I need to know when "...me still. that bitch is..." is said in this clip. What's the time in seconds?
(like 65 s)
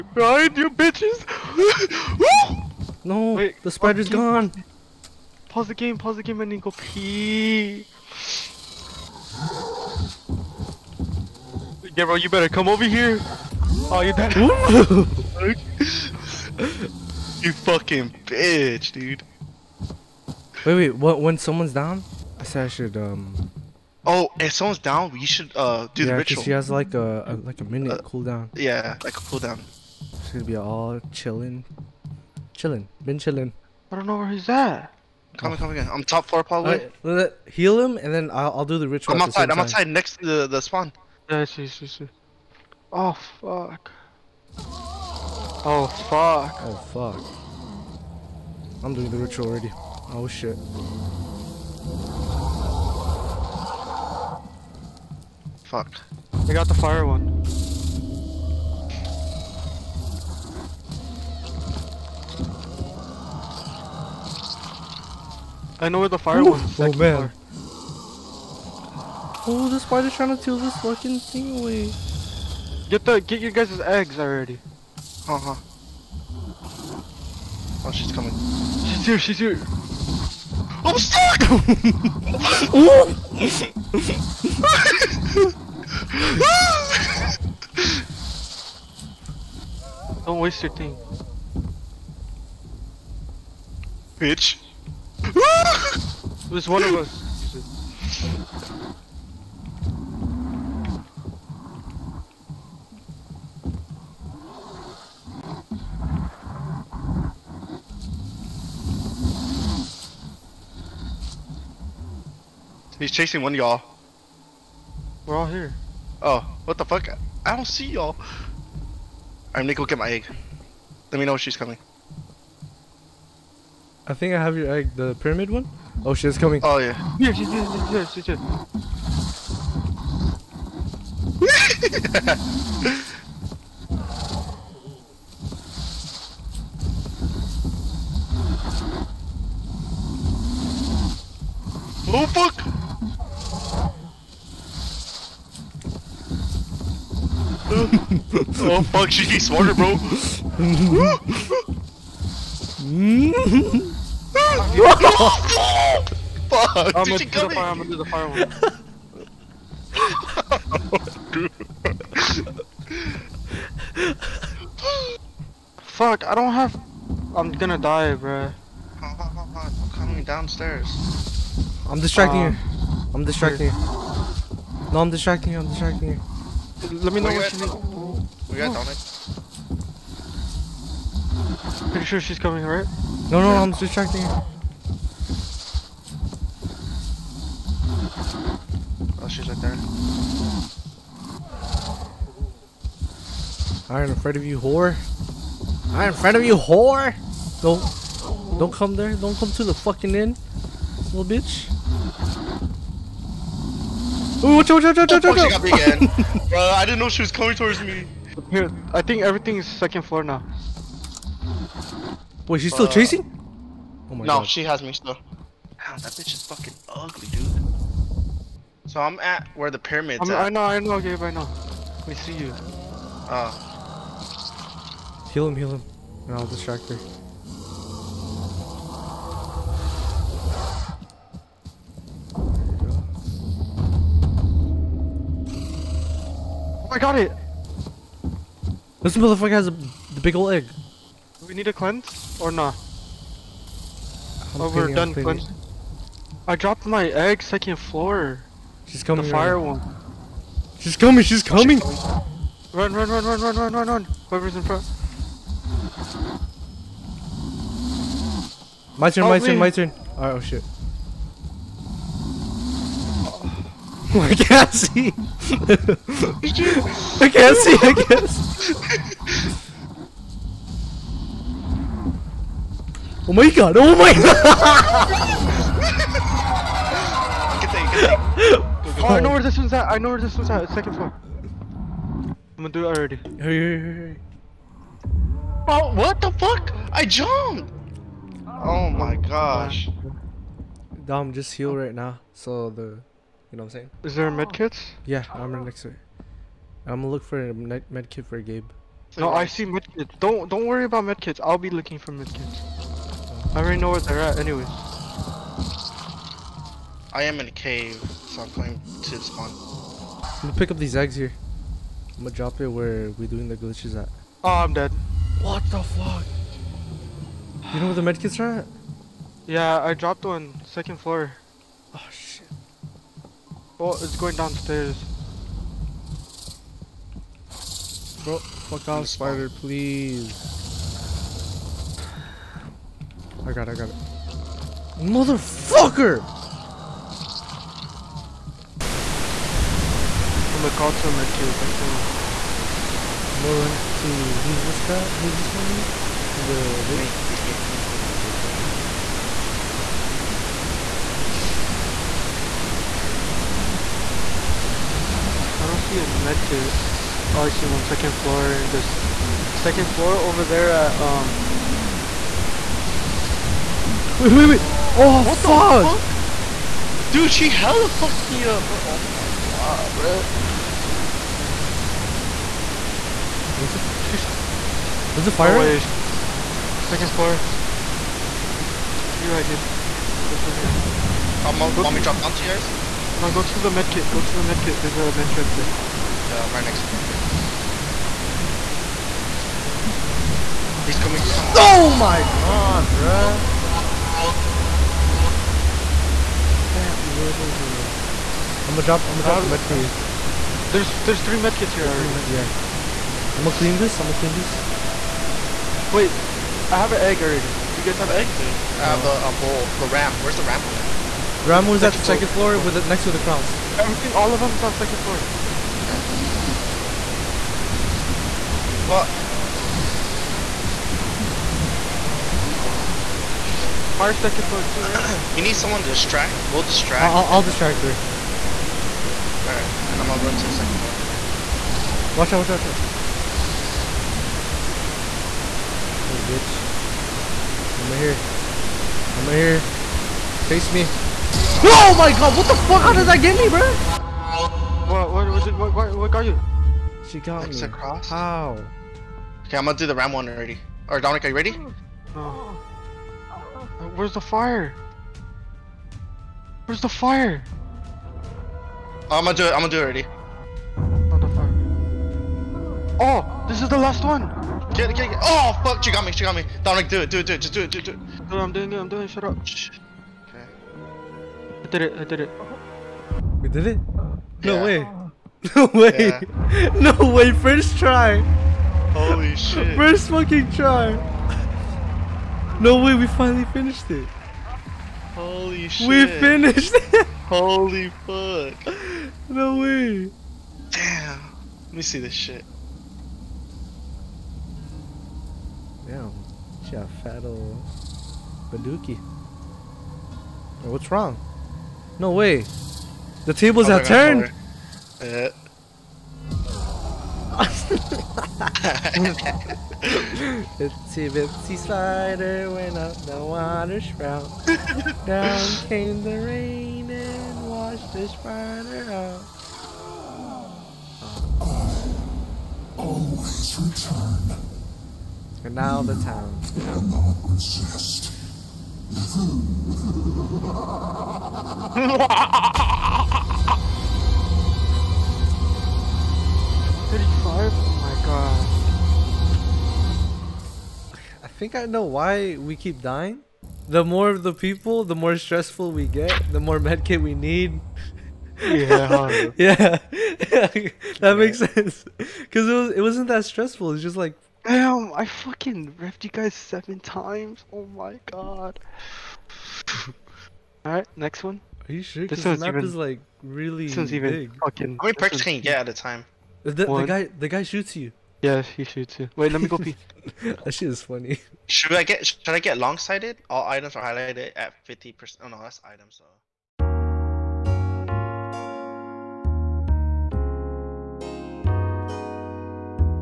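214 s.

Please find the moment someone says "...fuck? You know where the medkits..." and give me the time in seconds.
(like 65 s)
315 s.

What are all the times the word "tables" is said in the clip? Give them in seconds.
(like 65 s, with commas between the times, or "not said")
503 s.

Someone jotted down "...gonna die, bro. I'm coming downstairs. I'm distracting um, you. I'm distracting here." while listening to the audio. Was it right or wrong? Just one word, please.
right.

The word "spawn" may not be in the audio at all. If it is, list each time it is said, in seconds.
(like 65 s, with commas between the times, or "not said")
40 s, 309 s.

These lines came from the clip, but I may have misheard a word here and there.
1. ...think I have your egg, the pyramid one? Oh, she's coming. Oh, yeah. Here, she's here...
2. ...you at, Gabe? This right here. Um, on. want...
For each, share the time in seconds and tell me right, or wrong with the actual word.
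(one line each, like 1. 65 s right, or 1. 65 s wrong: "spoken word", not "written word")
1. 124 s right
2. 379 s right.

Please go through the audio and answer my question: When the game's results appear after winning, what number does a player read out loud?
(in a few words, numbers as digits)
35.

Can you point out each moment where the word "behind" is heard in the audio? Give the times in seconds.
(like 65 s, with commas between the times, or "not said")
0 s.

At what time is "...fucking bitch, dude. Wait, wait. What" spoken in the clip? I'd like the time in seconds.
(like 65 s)
17 s.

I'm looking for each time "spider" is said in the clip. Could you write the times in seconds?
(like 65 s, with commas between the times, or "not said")
3 s, 69 s, 329 s, 518 s.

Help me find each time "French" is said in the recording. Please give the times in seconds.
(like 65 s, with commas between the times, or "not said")
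not said.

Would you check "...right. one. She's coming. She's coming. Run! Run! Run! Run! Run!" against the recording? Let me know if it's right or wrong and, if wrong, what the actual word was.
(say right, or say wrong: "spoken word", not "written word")
right.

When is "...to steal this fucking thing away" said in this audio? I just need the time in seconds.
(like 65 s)
70 s.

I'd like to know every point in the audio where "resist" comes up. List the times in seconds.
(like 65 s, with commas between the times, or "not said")
527 s.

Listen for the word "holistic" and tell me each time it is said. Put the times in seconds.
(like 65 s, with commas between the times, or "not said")
not said.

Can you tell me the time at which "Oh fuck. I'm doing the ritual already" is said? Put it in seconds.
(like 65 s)
46 s.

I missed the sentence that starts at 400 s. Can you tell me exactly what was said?
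there's, there's three medkits here there's already.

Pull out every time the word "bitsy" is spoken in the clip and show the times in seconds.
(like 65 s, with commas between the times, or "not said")
511 s.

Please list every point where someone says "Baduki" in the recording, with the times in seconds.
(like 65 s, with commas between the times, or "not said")
498 s.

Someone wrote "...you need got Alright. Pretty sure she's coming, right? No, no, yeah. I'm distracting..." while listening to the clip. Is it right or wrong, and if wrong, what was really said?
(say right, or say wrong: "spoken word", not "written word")
wrong: "Dominic", not "Alright".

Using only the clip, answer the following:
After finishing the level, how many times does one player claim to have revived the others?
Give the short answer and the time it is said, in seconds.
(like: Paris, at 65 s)
7, at 556 s.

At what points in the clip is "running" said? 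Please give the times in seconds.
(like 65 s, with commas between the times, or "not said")
not said.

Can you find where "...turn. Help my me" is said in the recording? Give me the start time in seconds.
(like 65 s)
259 s.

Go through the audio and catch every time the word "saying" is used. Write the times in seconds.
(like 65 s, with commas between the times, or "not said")
293 s.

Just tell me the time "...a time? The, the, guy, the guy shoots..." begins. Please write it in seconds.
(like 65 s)
565 s.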